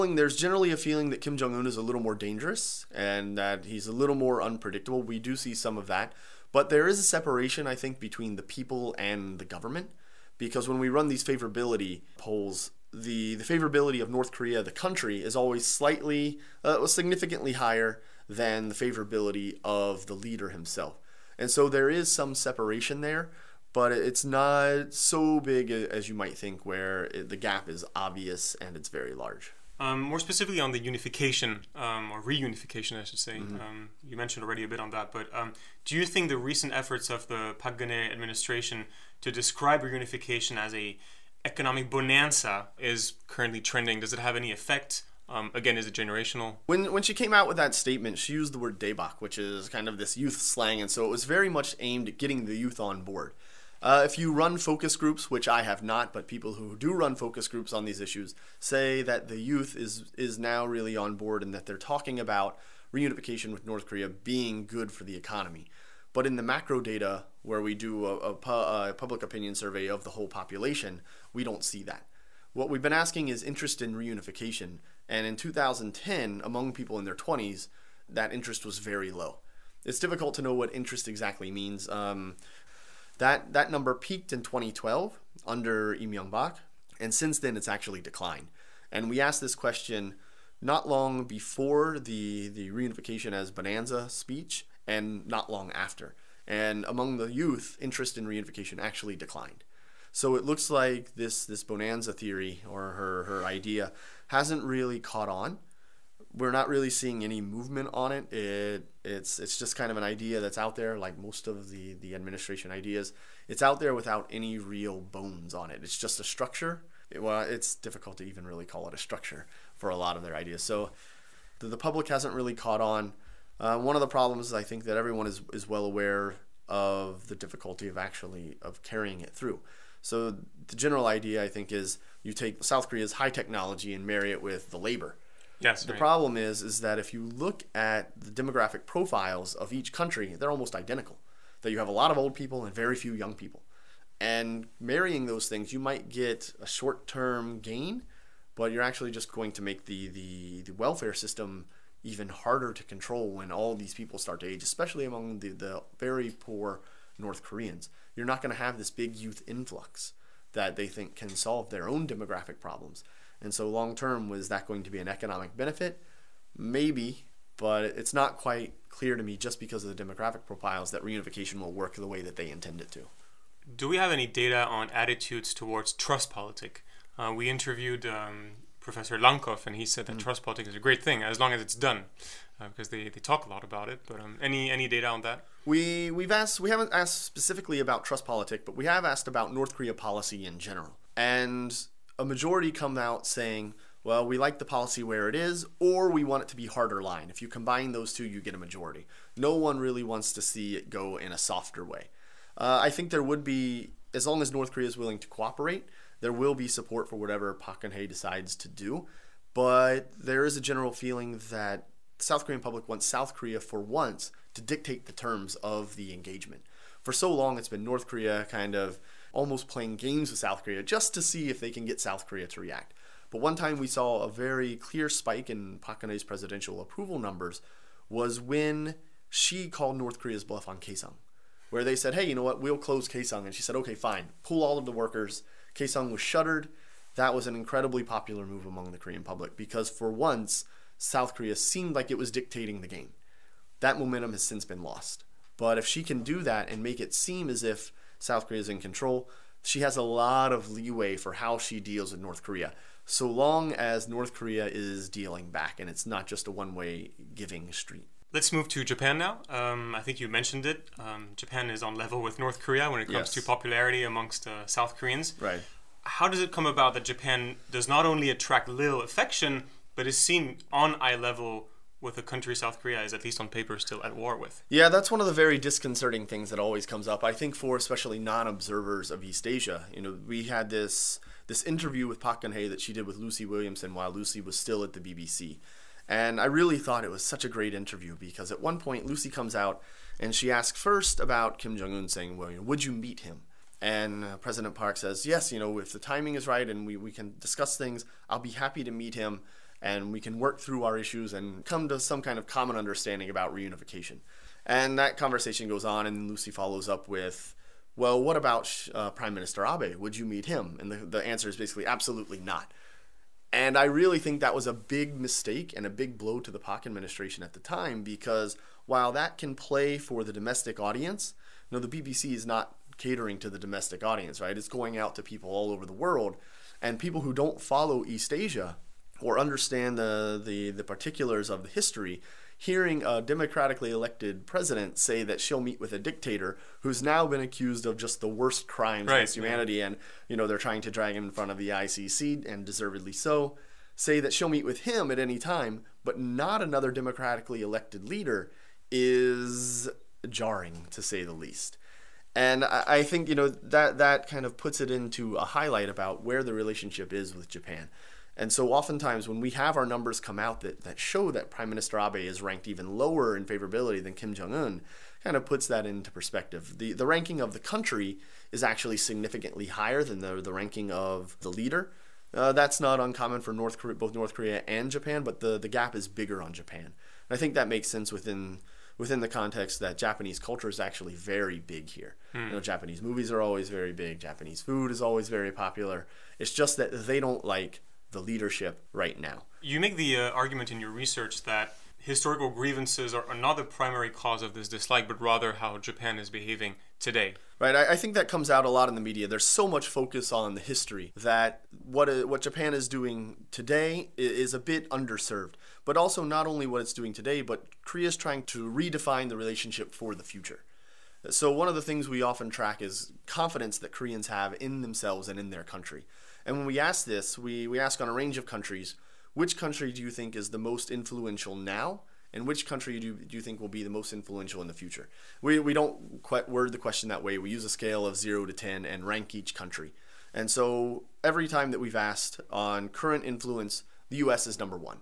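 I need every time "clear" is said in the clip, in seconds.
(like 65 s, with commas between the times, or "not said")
168 s, 224 s.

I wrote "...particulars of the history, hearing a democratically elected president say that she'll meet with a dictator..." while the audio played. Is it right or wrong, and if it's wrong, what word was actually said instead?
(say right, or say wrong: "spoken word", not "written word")
right.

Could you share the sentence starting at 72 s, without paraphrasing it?
What we've been asking is interest in reunification, and in 2010, among people in their 20s, that interest was very low.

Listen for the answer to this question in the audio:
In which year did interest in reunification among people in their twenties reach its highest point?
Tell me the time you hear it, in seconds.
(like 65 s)
84 s.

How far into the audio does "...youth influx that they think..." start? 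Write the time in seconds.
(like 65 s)
159 s.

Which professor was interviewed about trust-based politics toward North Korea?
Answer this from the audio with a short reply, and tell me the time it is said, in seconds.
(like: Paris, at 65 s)
Professor Lankov, at 178 s.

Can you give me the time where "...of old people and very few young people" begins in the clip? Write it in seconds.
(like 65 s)
142 s.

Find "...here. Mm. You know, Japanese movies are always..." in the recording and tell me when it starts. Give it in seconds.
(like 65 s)
381 s.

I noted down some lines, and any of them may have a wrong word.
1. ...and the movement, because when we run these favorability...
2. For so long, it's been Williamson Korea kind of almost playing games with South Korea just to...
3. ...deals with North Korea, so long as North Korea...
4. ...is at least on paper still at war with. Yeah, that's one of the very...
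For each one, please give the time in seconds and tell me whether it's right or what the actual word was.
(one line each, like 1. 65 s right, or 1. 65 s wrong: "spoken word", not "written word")
1. 8 s wrong: "government", not "movement"
2. 217 s wrong: "North", not "Williamson"
3. 251 s right
4. 273 s right.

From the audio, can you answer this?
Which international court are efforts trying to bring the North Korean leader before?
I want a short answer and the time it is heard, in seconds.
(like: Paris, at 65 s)
ICC, at 341 s.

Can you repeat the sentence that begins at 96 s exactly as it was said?
And among the youth, interest in reunification actually declined.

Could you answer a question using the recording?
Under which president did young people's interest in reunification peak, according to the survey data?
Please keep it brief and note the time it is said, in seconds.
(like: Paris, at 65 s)
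Lee Myung-bak, at 85 s.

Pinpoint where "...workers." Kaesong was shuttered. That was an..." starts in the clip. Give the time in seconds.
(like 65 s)
234 s.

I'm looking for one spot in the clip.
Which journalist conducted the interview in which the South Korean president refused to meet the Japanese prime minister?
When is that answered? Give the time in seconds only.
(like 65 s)
283 s.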